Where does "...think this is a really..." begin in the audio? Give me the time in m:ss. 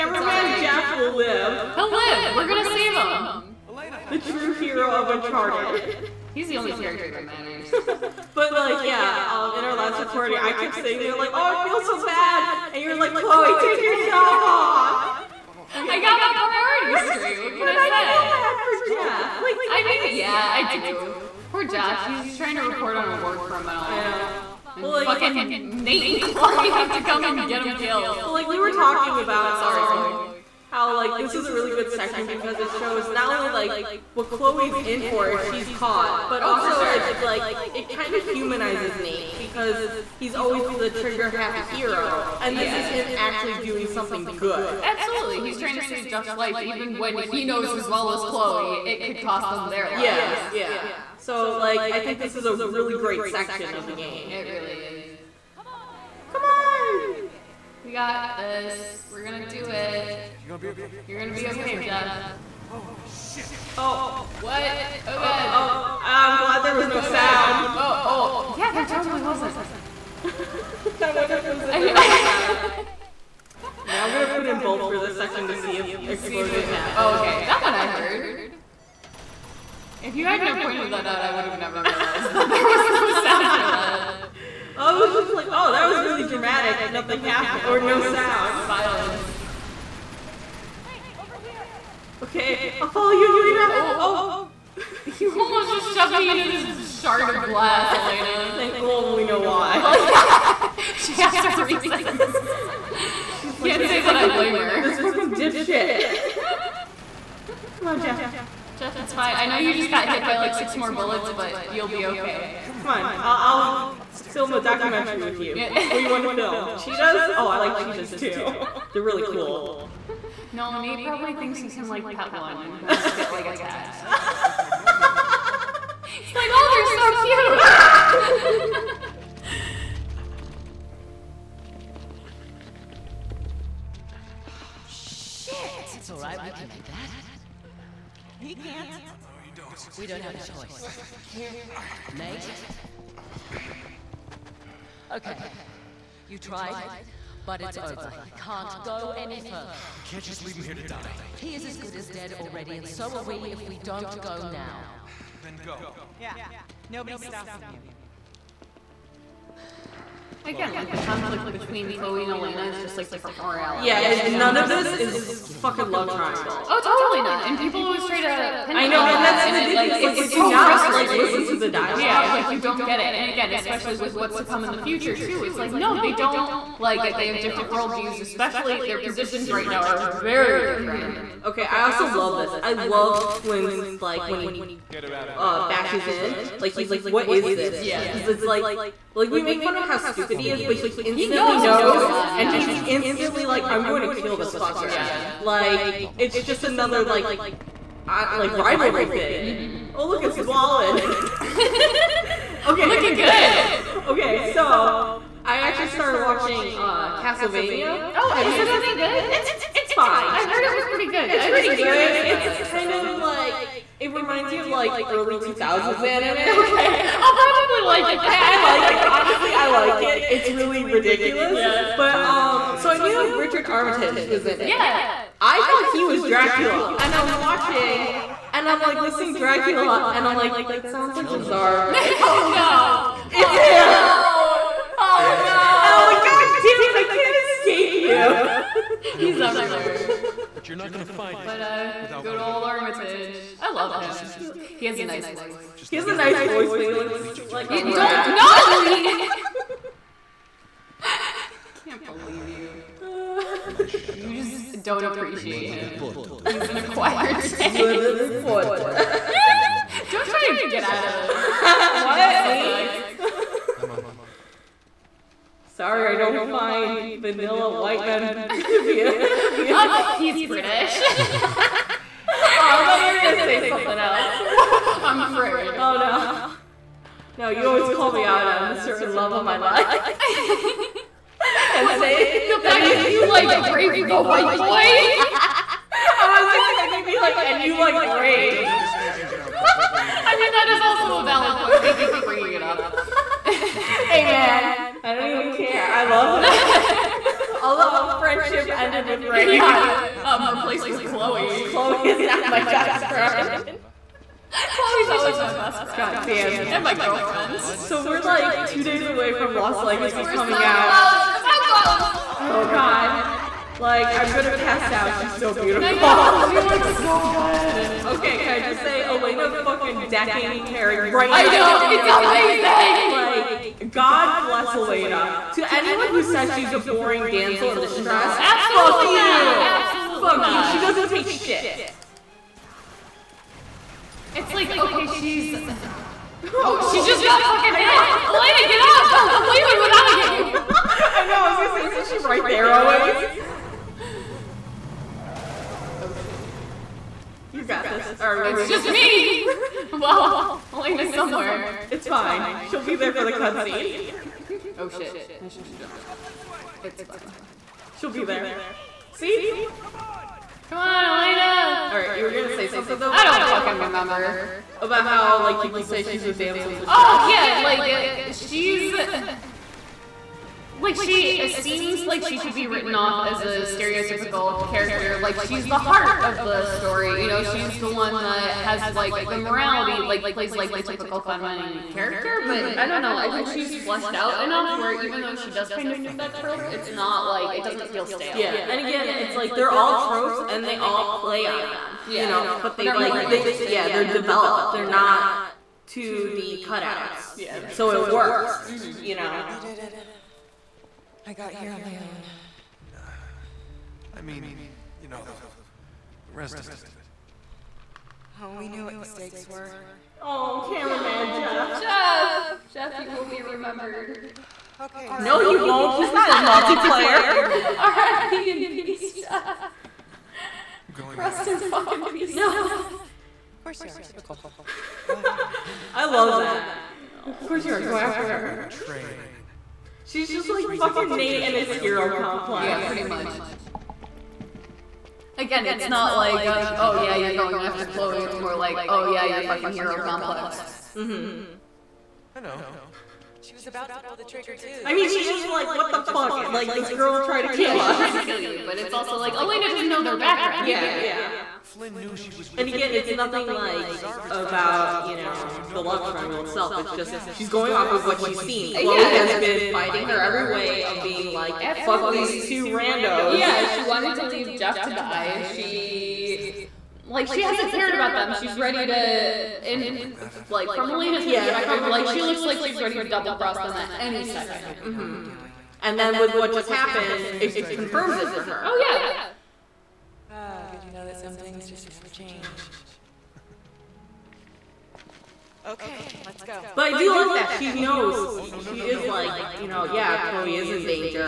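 0:51.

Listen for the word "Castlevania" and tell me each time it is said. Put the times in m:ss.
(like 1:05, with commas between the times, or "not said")
3:27.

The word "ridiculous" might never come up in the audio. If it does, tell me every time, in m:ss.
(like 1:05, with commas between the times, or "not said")
2:49, 3:40.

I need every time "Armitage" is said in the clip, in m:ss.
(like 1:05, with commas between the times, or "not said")
3:43, 4:02.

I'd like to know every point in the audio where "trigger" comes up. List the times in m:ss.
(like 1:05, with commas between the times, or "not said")
0:40, 7:24.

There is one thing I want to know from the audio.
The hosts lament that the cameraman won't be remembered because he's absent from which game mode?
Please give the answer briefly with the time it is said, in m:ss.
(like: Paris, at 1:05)
Multiplayer, at 6:56.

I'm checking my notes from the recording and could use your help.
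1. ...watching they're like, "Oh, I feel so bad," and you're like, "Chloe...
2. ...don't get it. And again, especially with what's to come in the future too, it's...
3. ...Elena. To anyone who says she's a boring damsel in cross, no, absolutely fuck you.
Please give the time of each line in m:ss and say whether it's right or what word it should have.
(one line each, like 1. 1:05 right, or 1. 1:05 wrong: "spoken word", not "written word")
1. 0:10 wrong: "saying", not "watching"
2. 2:52 right
3. 5:24 wrong: "distress", not "cross".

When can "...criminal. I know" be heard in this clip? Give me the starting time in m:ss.
0:23.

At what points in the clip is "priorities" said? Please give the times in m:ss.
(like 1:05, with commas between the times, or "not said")
0:16.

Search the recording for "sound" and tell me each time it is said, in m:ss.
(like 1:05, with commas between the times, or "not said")
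1:07, 1:23, 1:27, 3:50.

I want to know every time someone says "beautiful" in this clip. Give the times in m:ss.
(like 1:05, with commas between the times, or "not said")
4:28, 5:15.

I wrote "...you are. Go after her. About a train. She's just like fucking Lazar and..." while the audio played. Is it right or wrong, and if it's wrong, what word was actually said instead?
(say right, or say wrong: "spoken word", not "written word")
wrong: "Nate", not "Lazar".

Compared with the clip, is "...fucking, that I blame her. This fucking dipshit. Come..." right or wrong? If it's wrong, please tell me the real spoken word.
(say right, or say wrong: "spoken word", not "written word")
right.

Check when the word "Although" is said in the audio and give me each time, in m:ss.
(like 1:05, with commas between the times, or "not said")
4:57.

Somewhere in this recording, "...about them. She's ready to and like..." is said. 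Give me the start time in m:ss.
7:47.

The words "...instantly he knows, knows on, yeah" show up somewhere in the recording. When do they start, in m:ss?
3:10.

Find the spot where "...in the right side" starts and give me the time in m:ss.
1:11.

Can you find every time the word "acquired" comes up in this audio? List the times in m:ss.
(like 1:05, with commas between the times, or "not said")
4:16.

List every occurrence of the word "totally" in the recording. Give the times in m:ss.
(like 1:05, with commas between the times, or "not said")
1:08, 2:47.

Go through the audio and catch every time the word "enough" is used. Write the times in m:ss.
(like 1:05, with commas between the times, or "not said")
6:24.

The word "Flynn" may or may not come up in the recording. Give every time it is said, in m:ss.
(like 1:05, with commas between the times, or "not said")
3:03, 7:31.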